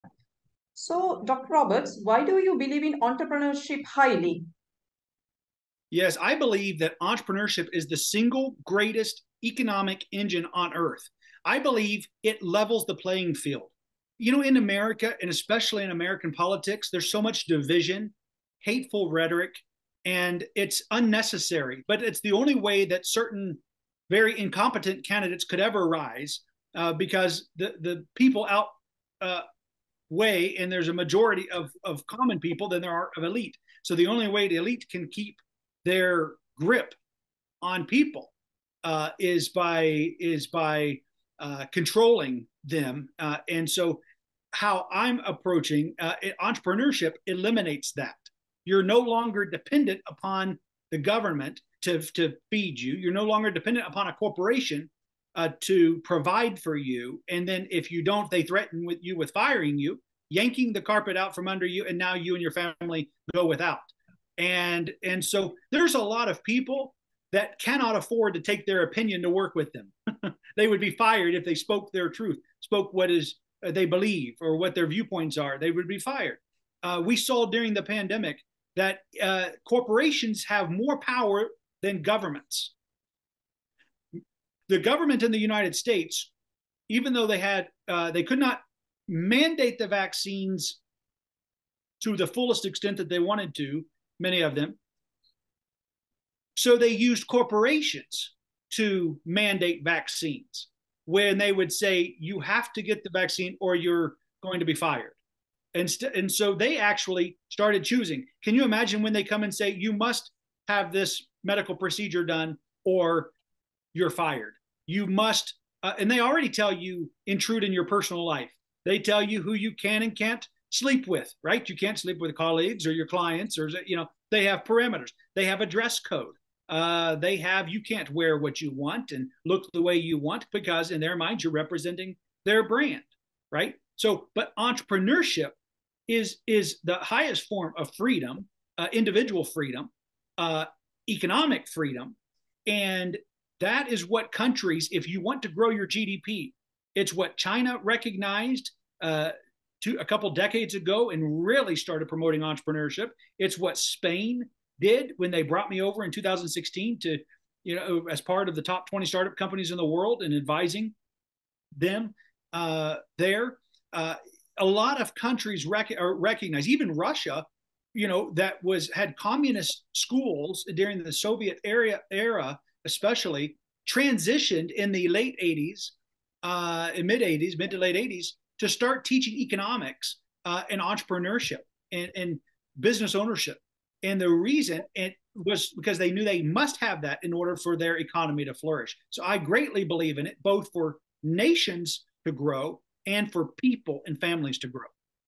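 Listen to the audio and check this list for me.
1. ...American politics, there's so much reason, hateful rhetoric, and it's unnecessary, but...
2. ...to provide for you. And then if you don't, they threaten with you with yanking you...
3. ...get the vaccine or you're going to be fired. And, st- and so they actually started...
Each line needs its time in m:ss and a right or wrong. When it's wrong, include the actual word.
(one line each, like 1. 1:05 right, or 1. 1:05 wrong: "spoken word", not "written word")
1. 0:15 wrong: "division", not "reason"
2. 0:55 wrong: "firing", not "yanking"
3. 1:42 right.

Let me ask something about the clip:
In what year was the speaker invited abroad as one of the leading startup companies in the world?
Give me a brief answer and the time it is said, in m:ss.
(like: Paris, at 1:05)
2016, at 2:36.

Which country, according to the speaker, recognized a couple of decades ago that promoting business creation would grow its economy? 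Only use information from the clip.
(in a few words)
China.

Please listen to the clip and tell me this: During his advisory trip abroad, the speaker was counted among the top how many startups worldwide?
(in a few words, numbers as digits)
20.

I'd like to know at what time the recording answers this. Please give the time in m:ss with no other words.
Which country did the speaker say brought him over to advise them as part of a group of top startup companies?
2:33.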